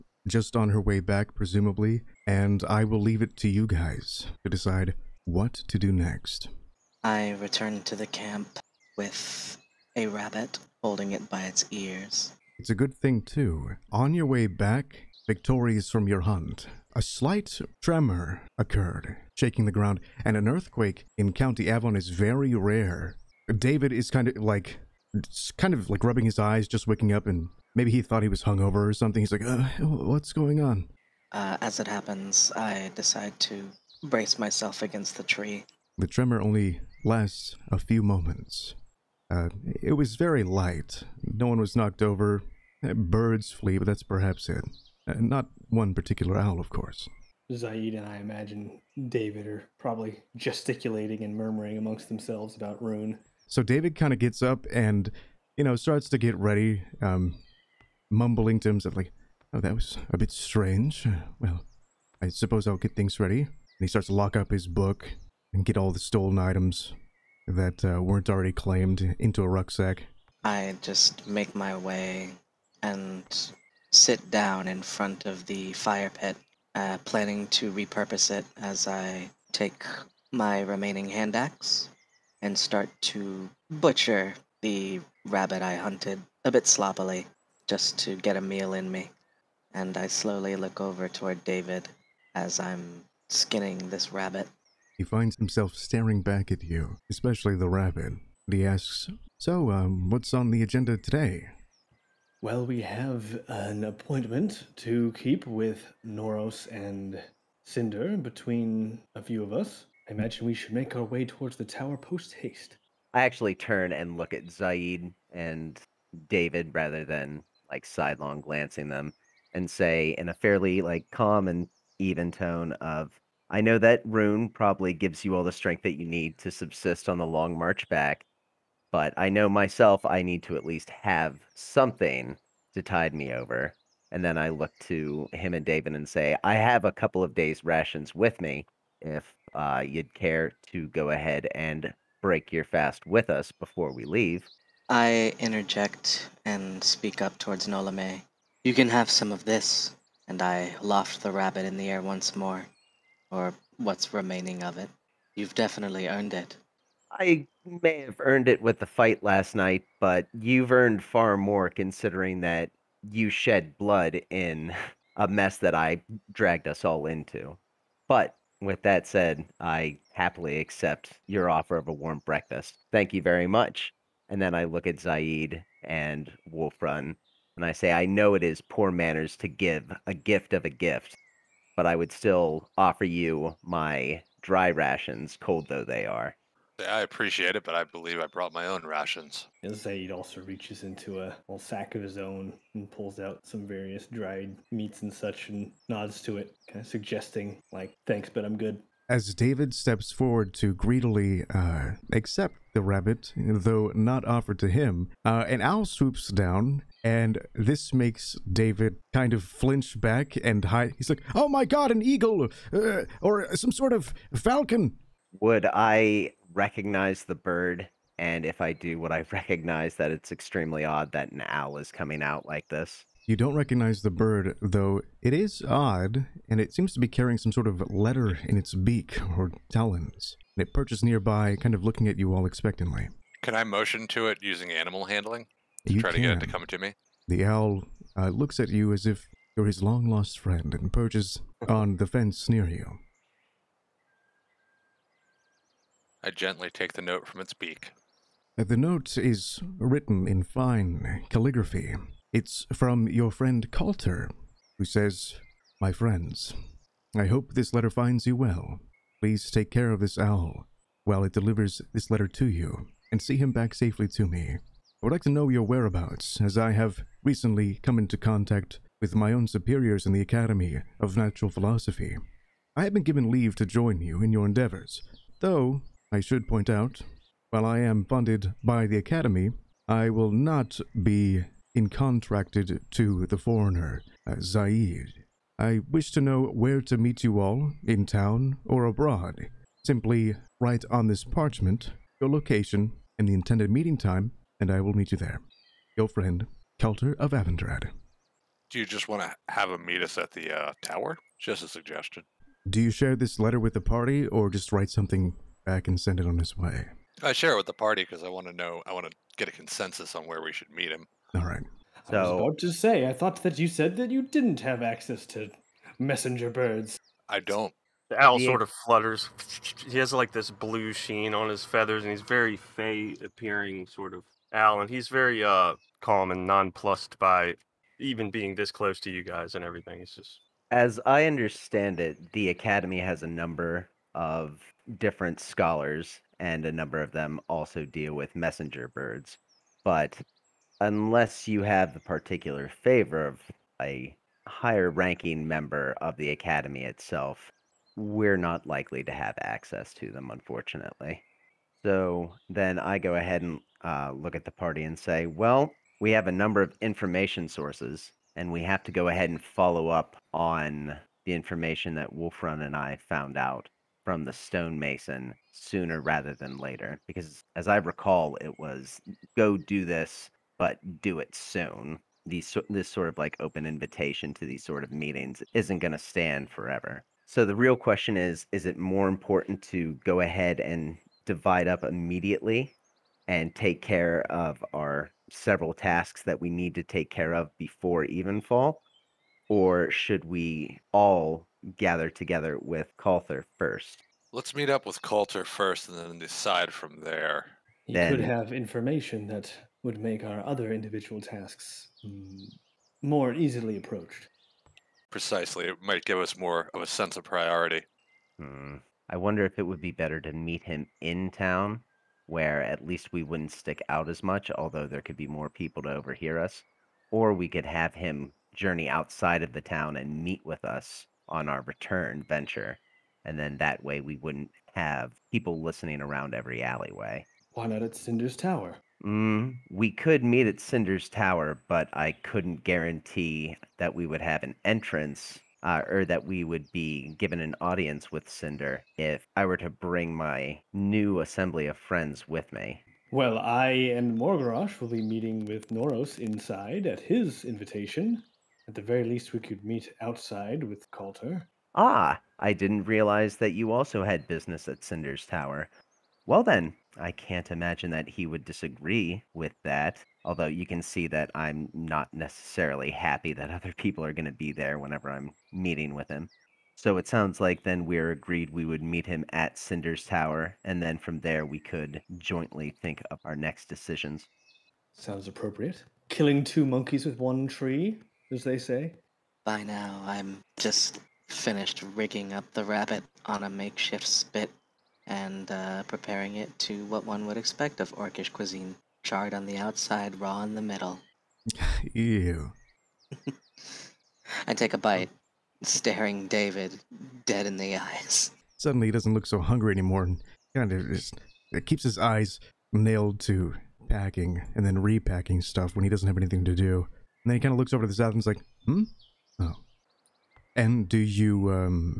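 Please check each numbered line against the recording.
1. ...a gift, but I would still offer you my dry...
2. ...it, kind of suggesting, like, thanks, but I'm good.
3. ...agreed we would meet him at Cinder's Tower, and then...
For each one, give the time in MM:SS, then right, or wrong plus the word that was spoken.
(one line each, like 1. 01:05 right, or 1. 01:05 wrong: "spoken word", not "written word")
1. 03:00 right
2. 03:16 right
3. 07:48 right.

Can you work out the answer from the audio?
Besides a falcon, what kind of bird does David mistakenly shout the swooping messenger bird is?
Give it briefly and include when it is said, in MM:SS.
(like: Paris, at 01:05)
An eagle, at 03:31.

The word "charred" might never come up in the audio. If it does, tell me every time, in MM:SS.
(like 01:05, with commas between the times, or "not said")
08:09.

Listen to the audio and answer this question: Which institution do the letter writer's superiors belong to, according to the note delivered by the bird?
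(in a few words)
Academy of Natural Philosophy.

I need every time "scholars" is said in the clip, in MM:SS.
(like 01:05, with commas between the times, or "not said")
05:35.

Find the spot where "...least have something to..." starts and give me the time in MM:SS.
02:10.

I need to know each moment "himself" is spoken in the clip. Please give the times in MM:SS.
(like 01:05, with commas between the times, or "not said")
00:58, 01:35.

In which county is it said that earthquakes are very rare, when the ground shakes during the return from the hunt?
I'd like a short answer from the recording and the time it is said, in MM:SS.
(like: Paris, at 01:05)
County Avon, at 00:21.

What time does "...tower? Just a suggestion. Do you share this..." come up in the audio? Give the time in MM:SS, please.
05:00.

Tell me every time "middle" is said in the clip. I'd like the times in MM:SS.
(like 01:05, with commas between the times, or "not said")
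08:10.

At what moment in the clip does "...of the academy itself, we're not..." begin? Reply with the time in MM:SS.
05:46.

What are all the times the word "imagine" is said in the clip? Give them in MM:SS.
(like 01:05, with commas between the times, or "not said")
00:48, 01:50, 07:37.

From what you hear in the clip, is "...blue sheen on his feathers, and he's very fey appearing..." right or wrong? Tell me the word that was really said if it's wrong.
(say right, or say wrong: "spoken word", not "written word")
right.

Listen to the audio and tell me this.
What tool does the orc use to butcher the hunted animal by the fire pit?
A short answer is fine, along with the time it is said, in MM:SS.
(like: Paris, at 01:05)
Hand axe, at 01:21.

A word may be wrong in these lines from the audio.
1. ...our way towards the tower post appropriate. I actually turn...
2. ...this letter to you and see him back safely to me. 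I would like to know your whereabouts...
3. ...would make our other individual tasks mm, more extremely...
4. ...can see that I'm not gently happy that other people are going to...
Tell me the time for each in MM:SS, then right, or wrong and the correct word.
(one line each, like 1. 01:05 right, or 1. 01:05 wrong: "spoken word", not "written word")
1. 01:50 wrong: "haste", not "appropriate"
2. 04:21 right
3. 06:39 wrong: "easily", not "extremely"
4. 07:40 wrong: "necessarily", not "gently".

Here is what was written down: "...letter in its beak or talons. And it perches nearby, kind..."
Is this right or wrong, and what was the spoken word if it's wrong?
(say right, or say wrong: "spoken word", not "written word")
right.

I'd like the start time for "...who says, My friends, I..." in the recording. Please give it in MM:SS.
04:14.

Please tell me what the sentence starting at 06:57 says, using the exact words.
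Or we could have him journey outside of the town and meet with us on our return venture.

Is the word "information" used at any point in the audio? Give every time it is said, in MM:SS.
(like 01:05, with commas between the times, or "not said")
05:56, 06:01, 06:38.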